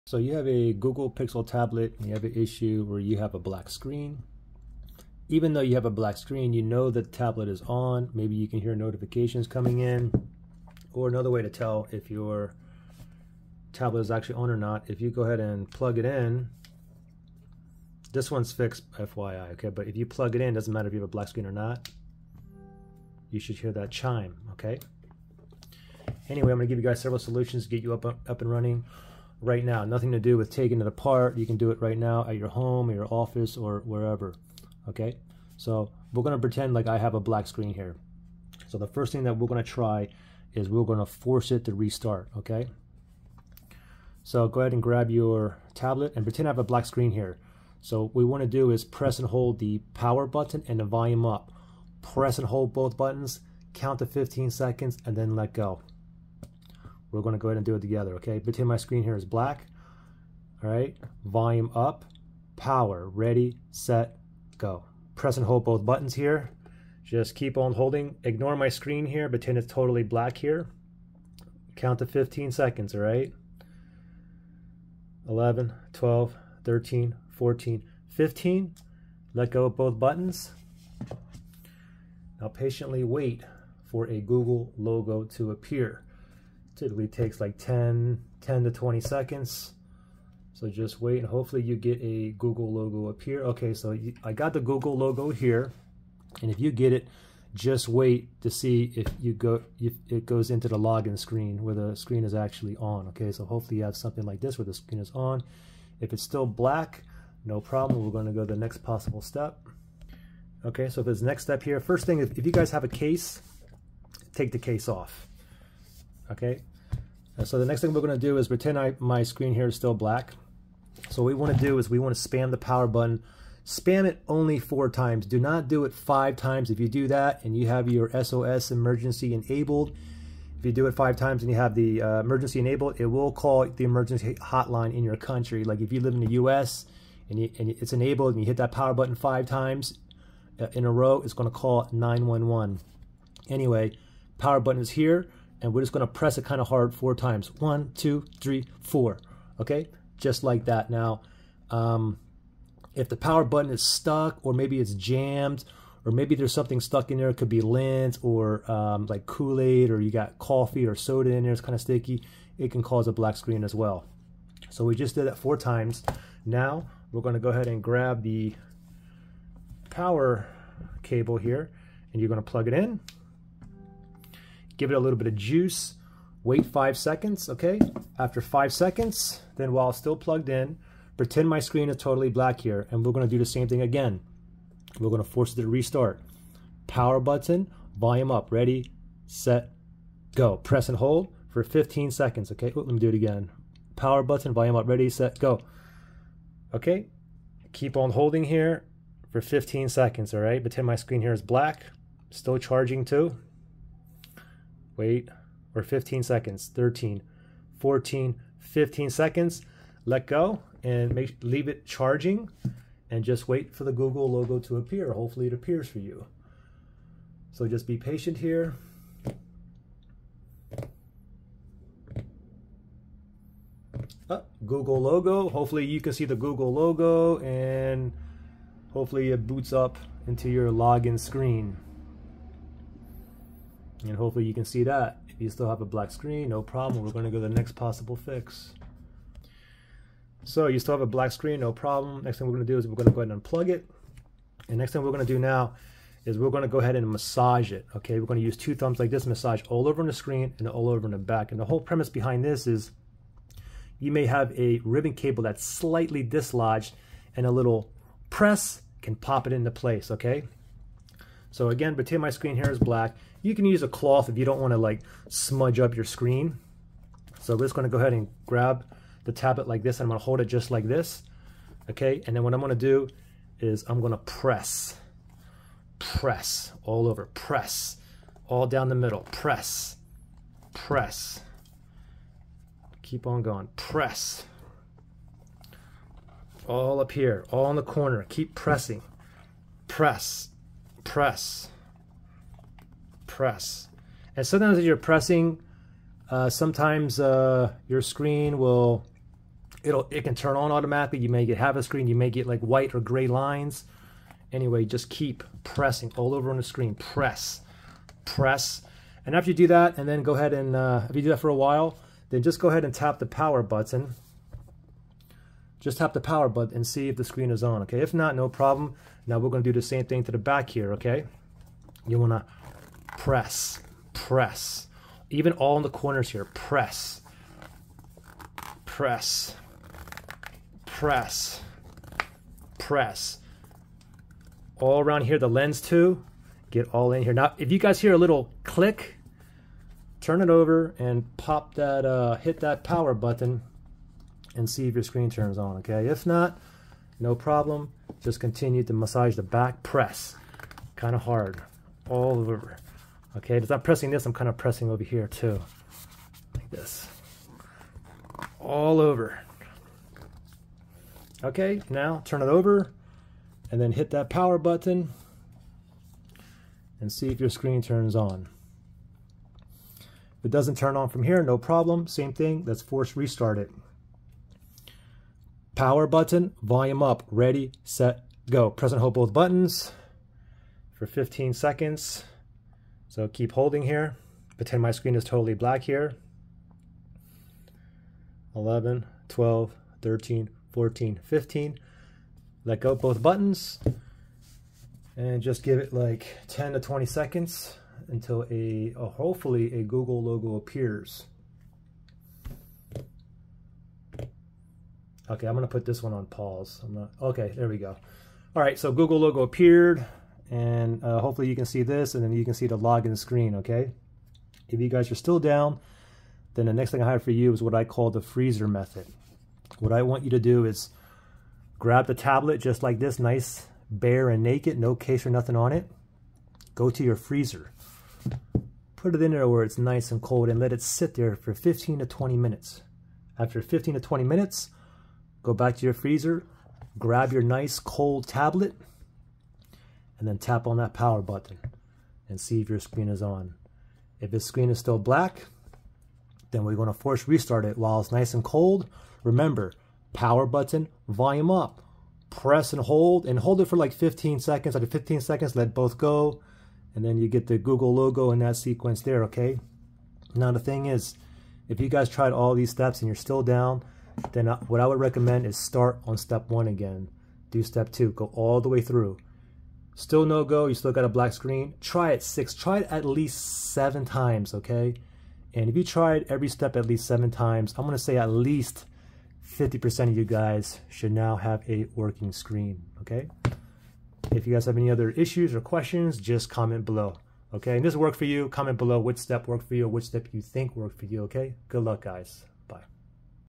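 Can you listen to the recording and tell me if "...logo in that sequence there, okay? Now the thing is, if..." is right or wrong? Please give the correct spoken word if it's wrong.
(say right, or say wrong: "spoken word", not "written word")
right.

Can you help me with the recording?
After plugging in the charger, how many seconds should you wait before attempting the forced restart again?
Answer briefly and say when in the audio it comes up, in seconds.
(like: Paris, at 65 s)
5, at 176 s.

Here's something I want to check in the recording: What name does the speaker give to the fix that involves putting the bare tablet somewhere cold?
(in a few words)
freezer method.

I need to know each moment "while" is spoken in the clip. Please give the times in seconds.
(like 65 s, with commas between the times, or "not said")
179 s, 311 s, 447 s.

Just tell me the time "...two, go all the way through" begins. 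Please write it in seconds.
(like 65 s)
467 s.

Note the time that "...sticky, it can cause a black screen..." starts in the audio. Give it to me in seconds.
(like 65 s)
161 s.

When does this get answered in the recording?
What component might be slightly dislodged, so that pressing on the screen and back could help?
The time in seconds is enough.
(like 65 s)
254 s.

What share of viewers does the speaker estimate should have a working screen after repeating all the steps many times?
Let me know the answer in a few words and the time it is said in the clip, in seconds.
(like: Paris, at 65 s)
50%, at 479 s.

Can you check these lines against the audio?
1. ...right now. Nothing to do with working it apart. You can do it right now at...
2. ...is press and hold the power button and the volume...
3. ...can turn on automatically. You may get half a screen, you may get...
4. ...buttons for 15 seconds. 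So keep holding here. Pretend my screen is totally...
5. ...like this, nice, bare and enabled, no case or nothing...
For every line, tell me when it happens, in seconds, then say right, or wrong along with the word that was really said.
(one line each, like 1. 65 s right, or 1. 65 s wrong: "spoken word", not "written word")
1. 29 s wrong: "taking", not "working"
2. 48 s right
3. 300 s right
4. 379 s right
5. 422 s wrong: "naked", not "enabled".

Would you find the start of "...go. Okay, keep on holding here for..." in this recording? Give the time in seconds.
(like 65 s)
195 s.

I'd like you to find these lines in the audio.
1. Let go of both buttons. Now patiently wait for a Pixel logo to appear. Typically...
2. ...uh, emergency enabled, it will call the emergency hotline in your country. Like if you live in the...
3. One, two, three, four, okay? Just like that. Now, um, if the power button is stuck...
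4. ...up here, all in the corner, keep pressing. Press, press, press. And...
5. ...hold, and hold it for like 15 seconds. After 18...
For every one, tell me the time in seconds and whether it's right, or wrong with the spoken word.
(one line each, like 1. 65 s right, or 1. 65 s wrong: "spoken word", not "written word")
1. 79 s wrong: "Google", not "Pixel"
2. 132 s right
3. 147 s right
4. 287 s right
5. 452 s wrong: "15", not "18".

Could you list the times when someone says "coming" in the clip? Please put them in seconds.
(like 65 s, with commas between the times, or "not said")
9 s.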